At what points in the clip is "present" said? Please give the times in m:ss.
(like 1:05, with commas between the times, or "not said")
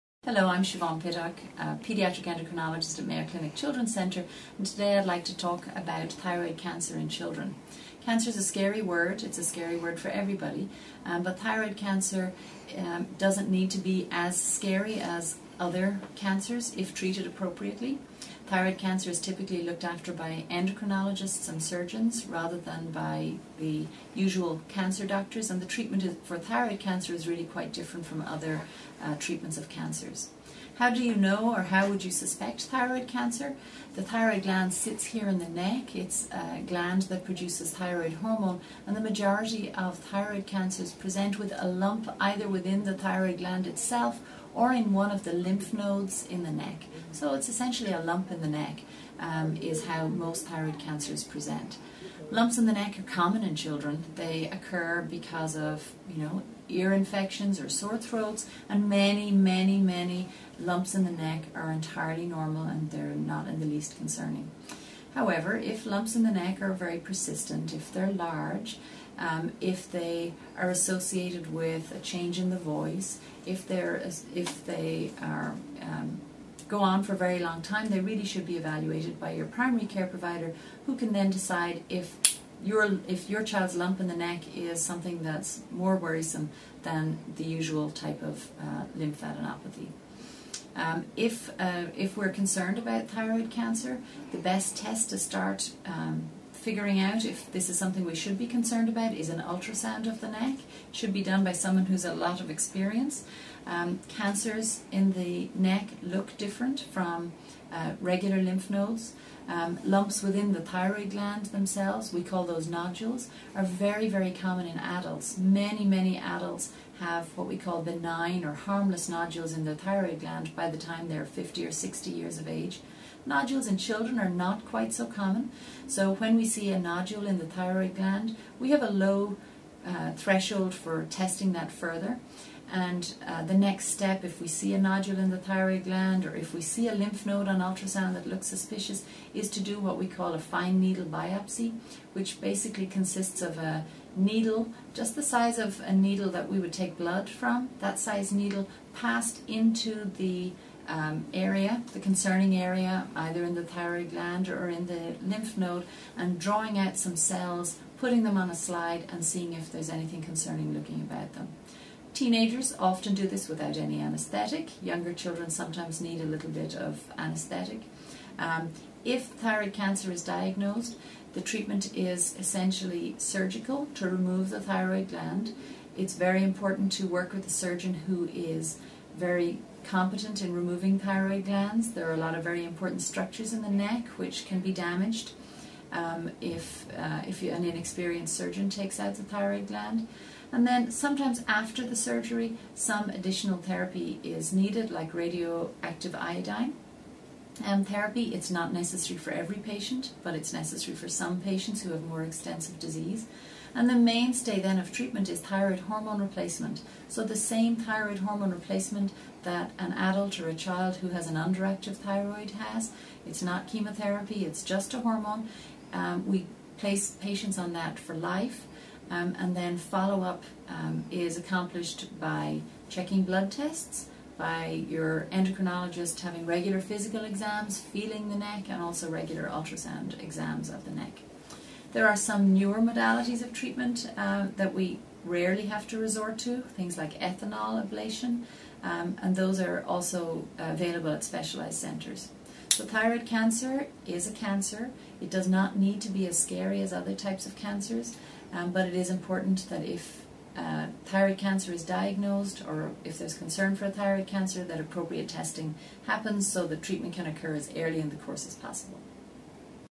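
0:40, 0:51.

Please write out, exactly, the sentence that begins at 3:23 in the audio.
And the mainstay then of treatment is thyroid hormone replacement.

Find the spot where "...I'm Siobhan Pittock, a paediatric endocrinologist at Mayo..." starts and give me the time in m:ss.
0:00.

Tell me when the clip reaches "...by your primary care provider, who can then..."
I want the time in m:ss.
1:19.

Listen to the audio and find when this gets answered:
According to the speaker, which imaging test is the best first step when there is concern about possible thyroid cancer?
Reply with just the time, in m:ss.
1:39.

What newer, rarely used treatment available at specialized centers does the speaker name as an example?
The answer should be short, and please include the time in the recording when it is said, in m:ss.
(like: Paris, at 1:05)
ethanol ablation, at 3:57.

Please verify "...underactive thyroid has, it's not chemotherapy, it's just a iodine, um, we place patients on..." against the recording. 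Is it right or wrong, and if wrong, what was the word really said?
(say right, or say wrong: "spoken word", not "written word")
wrong: "hormone", not "iodine".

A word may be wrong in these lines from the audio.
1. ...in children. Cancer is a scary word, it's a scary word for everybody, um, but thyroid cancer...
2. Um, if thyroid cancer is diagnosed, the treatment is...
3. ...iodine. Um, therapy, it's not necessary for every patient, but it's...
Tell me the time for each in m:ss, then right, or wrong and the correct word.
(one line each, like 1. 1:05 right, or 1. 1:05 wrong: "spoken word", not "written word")
1. 0:06 right
2. 2:48 right
3. 3:16 right.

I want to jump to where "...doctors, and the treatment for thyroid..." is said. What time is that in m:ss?
0:25.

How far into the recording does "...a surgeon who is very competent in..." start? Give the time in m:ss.
2:57.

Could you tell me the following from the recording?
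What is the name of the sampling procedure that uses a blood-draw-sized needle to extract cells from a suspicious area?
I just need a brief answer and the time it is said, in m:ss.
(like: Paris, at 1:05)
fine needle biopsy, at 2:20.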